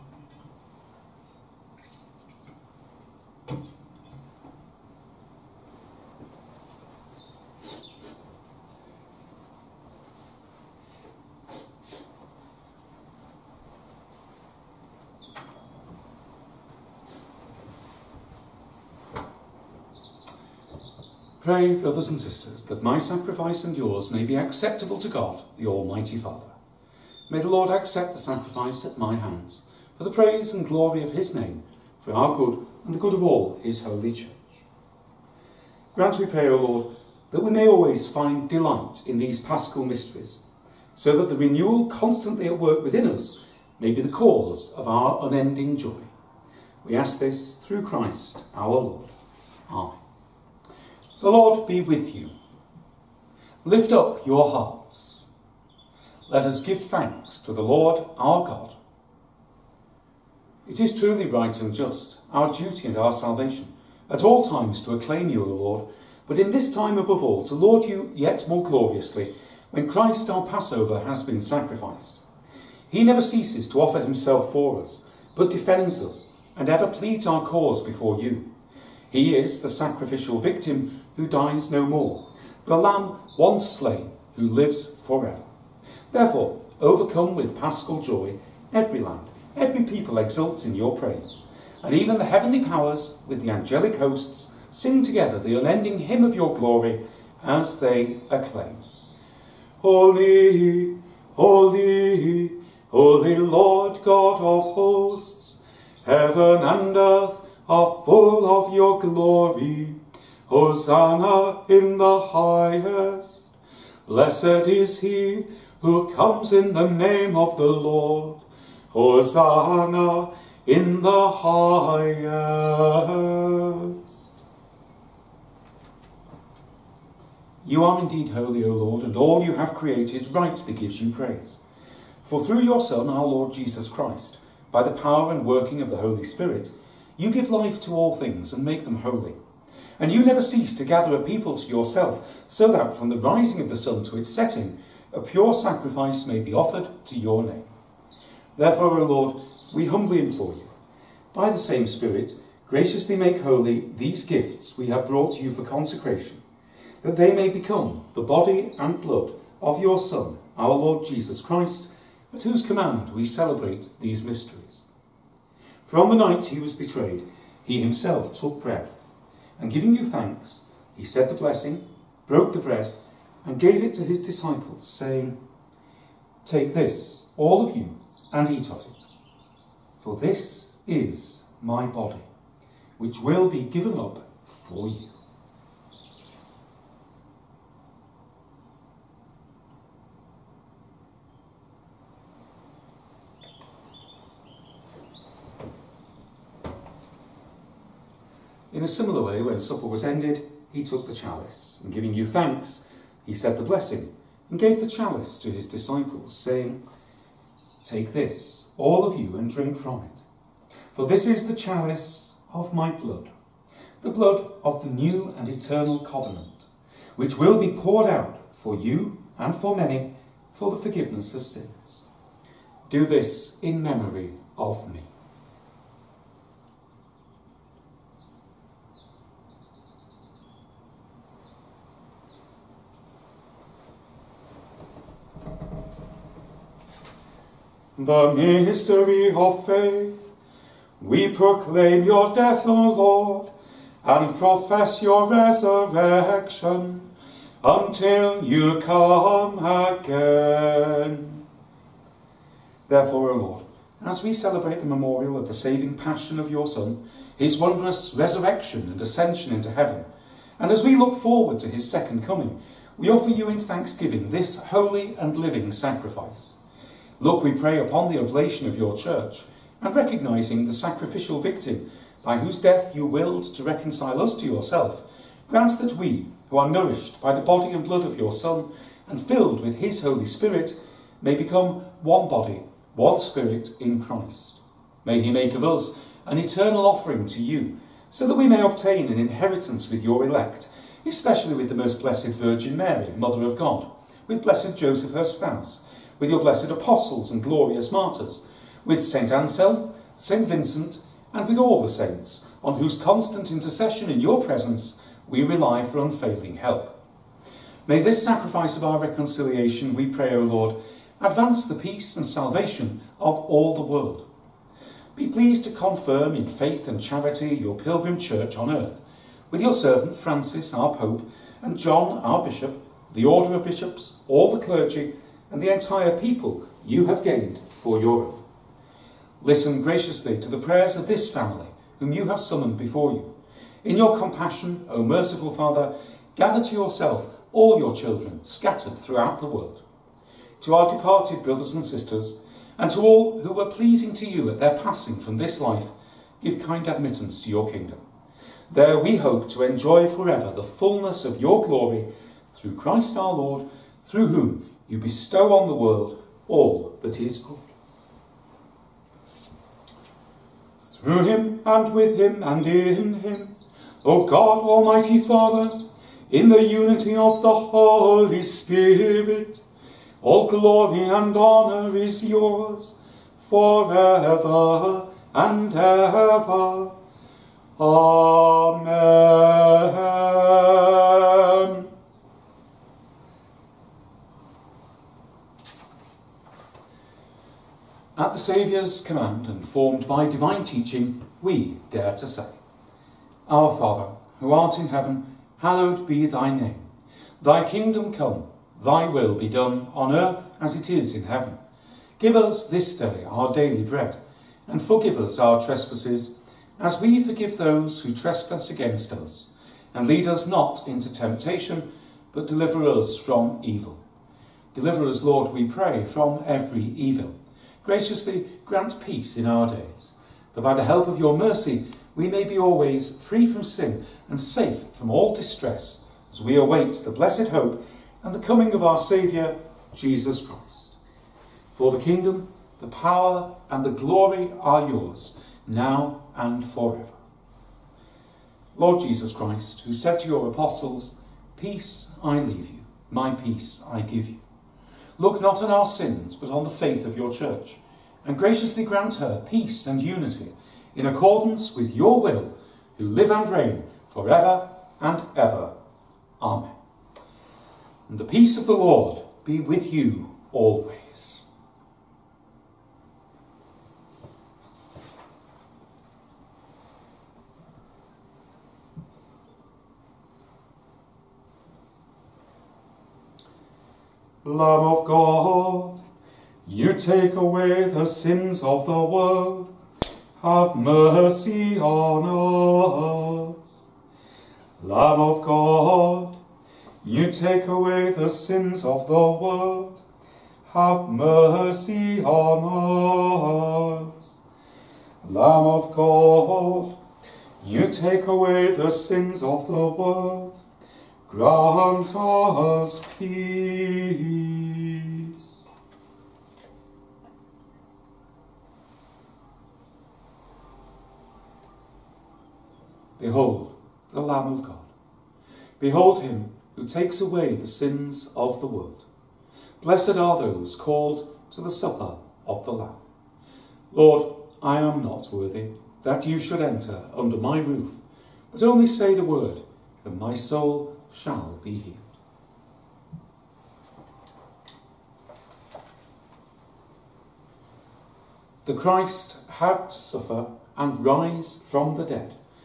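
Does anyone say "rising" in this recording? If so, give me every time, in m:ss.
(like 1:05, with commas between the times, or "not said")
2:23.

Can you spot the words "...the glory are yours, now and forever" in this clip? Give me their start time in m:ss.
7:13.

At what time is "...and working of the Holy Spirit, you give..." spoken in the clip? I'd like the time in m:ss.
2:15.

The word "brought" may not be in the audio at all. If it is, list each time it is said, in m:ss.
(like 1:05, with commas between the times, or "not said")
2:35.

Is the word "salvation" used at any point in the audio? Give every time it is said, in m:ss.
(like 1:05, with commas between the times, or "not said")
1:03, 5:12.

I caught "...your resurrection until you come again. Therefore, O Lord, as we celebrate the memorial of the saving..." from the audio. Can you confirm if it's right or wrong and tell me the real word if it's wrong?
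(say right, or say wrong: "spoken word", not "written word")
right.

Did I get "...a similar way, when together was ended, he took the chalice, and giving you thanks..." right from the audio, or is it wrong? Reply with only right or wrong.
wrong.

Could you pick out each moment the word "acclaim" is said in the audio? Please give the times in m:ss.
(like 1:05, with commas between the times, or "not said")
1:04, 1:38.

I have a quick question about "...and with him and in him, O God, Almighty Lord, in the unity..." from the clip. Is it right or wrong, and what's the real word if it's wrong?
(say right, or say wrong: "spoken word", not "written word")
wrong: "Father", not "Lord".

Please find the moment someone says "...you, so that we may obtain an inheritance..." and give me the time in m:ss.
4:47.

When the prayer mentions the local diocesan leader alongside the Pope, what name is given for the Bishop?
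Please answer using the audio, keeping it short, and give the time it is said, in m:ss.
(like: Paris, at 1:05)
John, at 5:21.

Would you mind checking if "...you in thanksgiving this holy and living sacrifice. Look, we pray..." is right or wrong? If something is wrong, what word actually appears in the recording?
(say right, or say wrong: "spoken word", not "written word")
right.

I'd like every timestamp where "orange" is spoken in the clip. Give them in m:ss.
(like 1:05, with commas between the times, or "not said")
not said.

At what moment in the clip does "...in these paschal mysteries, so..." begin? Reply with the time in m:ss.
0:39.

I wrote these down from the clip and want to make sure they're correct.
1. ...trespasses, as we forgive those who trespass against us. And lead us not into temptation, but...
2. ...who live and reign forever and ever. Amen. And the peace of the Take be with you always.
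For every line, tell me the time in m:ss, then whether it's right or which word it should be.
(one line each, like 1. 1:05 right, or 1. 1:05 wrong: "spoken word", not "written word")
1. 6:45 right
2. 7:32 wrong: "Lord", not "Take".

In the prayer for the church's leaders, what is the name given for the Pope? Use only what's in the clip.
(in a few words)
Francis.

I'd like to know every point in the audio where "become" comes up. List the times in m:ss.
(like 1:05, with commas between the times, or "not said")
2:37, 4:41.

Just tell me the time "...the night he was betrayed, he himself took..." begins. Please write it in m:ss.
2:46.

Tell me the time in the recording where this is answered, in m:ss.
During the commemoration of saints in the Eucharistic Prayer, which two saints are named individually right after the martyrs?
4:59.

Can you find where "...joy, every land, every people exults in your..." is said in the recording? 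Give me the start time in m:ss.
1:28.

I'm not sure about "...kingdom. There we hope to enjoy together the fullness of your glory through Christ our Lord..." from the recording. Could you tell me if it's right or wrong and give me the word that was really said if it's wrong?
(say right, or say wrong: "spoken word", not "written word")
wrong: "forever", not "together".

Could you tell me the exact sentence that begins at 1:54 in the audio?
Blessed is he who comes in the name of the Lord.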